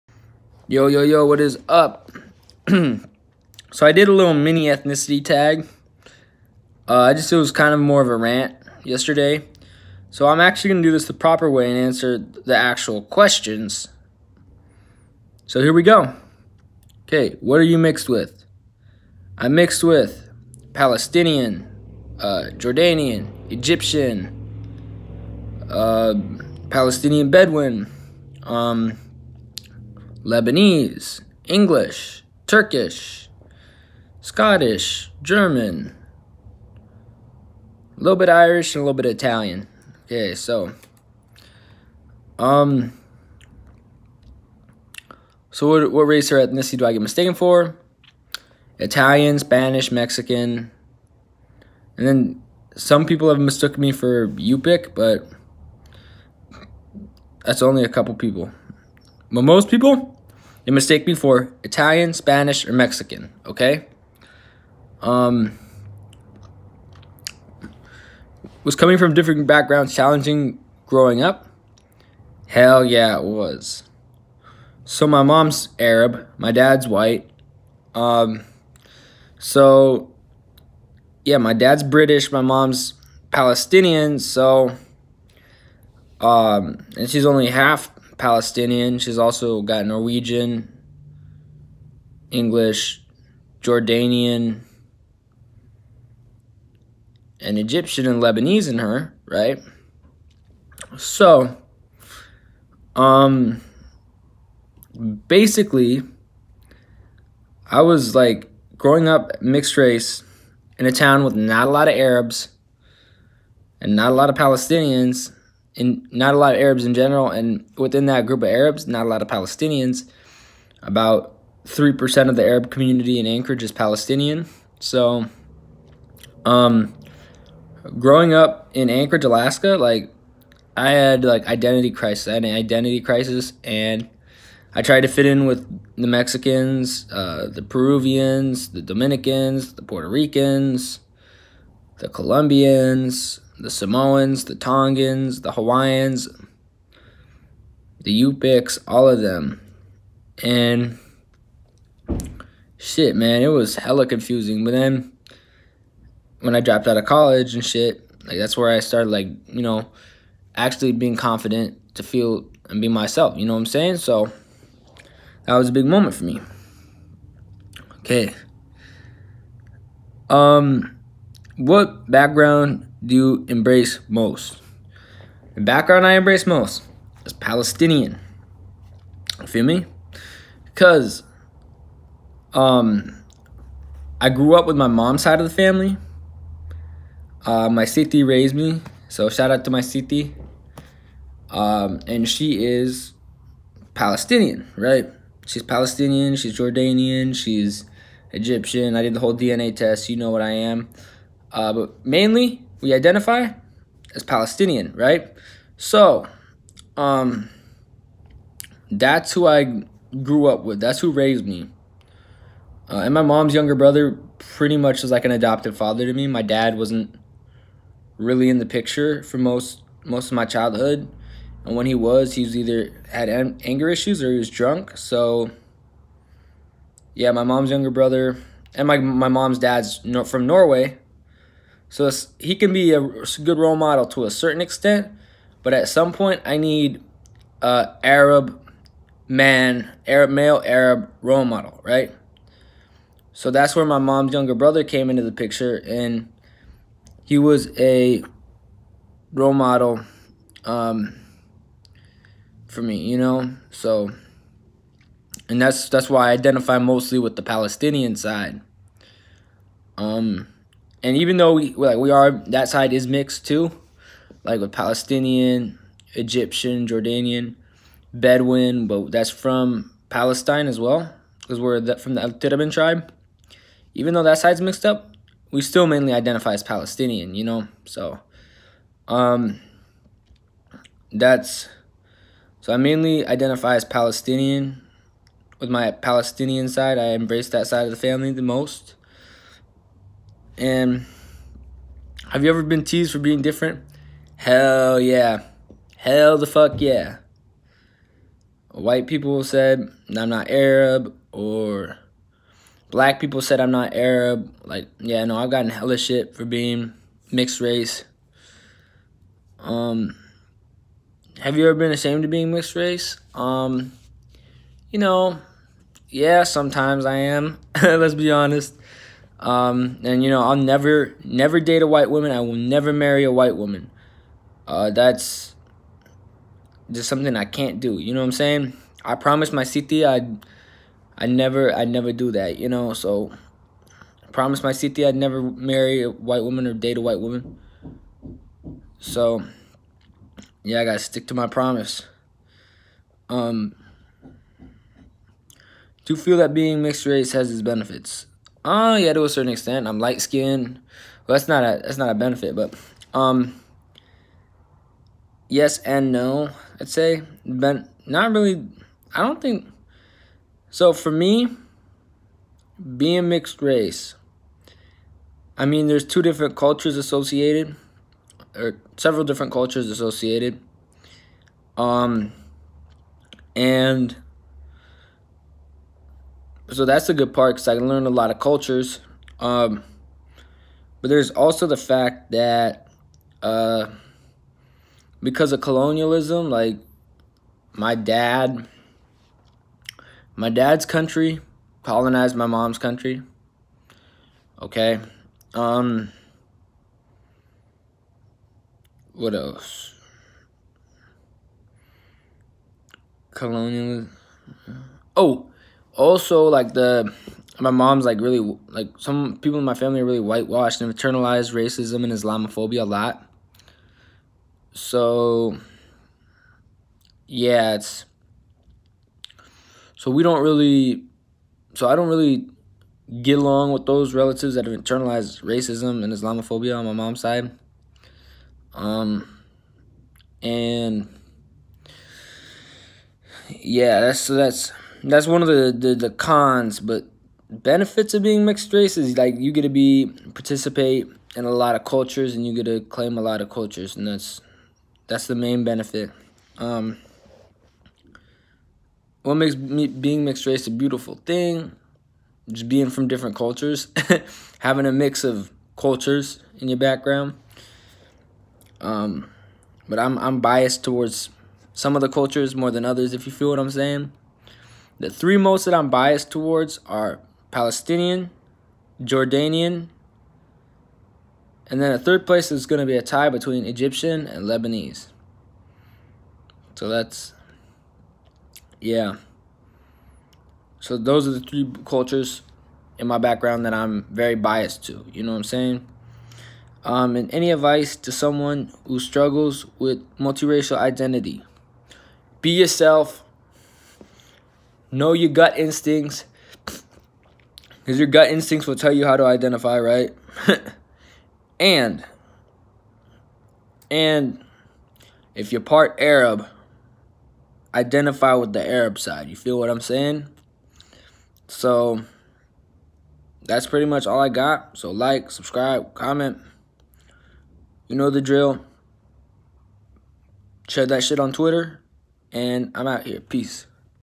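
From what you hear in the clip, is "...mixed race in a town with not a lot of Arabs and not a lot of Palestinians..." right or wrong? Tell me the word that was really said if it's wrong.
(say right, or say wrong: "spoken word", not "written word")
right.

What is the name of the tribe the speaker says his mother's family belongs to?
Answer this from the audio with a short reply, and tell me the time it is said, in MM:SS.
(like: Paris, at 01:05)
Al Tirabin, at 04:32.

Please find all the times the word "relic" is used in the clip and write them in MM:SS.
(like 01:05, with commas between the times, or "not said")
not said.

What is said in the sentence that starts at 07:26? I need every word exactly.
Um, what makes me, being mixed race a beautiful thing?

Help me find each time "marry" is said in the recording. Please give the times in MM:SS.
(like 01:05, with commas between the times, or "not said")
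05:22, 05:35.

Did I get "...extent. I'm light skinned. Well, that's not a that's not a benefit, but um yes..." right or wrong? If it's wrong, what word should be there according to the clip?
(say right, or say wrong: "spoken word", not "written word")
right.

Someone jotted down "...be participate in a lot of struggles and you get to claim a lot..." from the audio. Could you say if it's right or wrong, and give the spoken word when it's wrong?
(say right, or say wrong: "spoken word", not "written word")
wrong: "cultures", not "struggles".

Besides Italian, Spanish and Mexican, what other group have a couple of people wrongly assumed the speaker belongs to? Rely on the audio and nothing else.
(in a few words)
Yupik.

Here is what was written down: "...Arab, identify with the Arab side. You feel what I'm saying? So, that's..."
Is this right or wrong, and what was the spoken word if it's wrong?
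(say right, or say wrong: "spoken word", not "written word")
right.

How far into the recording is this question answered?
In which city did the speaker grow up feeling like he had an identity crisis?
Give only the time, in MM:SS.
02:08.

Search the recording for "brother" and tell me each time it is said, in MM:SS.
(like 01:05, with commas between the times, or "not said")
03:33, 03:47, 04:04.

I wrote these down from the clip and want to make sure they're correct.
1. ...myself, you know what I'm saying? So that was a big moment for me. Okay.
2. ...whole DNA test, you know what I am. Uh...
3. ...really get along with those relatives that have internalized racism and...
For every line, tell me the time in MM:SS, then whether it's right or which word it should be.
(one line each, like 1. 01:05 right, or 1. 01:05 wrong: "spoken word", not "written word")
1. 02:42 right
2. 03:19 right
3. 07:02 right.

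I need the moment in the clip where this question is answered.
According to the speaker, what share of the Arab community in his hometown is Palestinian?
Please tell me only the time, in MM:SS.
02:01.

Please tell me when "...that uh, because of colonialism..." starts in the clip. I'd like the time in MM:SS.
06:22.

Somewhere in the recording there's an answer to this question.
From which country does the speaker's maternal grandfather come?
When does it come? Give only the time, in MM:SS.
03:50.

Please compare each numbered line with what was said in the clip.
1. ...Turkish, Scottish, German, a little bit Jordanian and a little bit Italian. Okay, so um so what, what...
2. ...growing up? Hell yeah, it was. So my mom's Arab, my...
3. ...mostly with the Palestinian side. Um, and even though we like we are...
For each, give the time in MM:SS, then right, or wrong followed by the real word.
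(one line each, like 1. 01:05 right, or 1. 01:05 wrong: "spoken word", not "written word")
1. 00:32 wrong: "Irish", not "Jordanian"
2. 01:10 right
3. 04:16 right.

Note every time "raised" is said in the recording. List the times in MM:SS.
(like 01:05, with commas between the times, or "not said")
03:08, 03:31.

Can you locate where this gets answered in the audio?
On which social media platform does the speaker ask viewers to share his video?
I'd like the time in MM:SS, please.
08:41.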